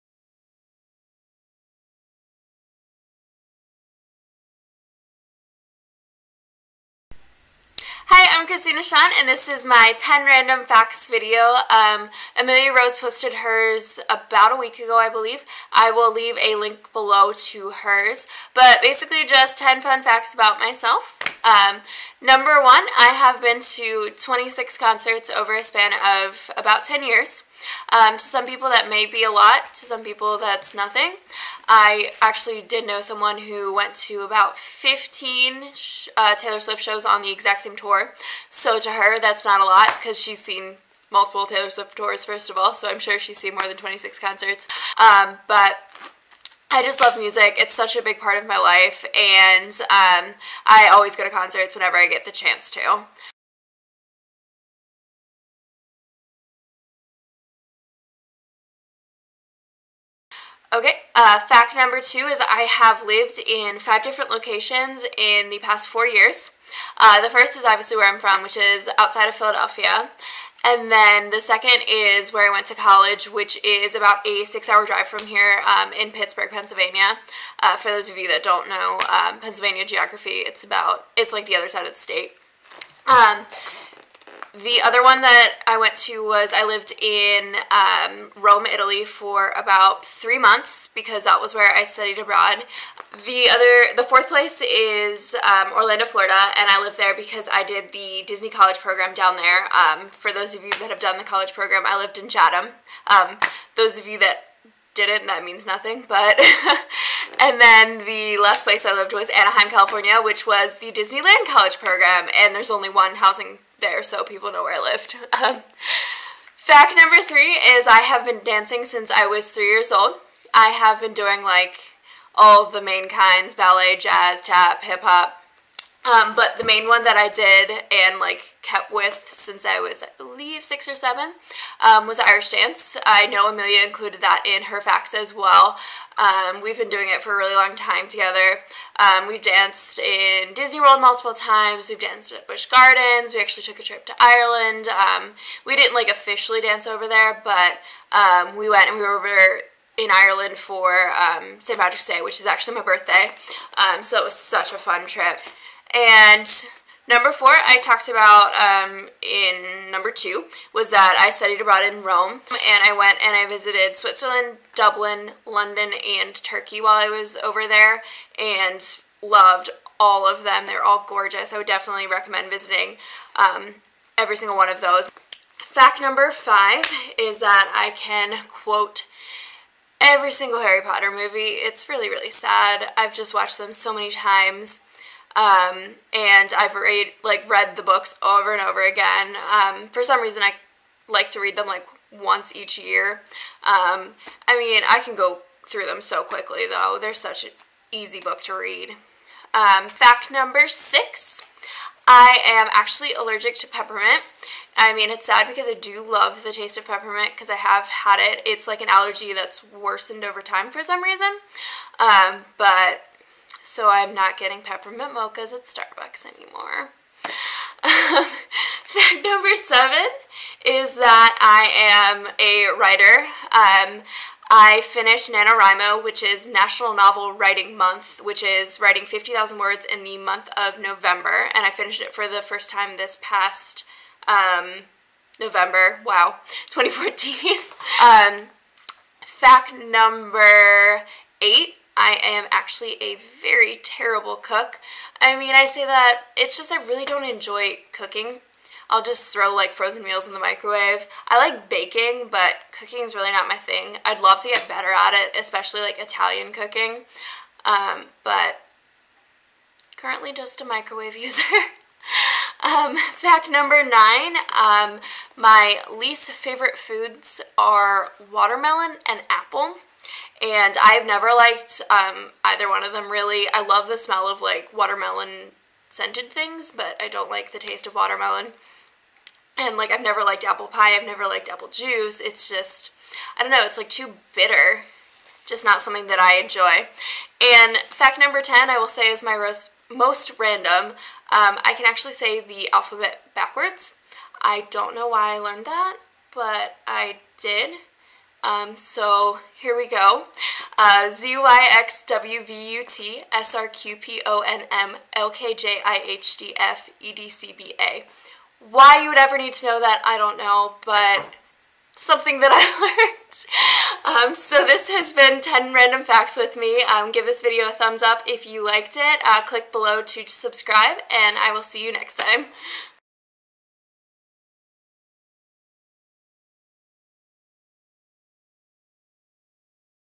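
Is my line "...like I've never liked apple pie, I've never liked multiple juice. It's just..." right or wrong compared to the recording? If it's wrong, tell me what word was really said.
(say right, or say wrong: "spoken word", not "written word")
wrong: "apple", not "multiple".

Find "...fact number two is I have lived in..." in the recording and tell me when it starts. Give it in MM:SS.
01:01.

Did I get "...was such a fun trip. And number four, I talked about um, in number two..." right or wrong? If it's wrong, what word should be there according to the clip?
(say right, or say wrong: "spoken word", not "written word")
right.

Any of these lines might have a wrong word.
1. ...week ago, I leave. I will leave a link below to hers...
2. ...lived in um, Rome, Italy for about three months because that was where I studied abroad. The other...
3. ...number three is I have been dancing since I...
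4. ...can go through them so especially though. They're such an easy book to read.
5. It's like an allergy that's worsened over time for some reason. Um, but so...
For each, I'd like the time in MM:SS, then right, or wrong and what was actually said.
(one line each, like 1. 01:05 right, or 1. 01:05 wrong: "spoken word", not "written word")
1. 00:14 wrong: "believe", not "leave"
2. 01:26 right
3. 01:56 right
4. 03:15 wrong: "quickly", not "especially"
5. 03:28 right.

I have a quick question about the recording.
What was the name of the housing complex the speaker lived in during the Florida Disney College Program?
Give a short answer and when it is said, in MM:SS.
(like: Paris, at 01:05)
Chatham, at 01:42.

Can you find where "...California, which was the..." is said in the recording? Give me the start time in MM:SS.
01:49.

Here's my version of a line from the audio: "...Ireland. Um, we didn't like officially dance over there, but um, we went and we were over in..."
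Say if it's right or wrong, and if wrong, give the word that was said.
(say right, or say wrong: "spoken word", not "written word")
right.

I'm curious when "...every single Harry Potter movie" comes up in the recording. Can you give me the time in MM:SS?
03:00.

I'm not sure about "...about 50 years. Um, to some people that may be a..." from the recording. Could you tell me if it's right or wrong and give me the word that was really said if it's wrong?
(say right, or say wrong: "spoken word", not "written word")
wrong: "10", not "50".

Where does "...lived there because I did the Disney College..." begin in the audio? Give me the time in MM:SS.
01:36.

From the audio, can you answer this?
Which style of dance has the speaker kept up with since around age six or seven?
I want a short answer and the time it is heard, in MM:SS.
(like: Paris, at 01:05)
Irish dance, at 02:12.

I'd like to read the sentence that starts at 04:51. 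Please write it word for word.
Um, I can actually say the alphabet backwards.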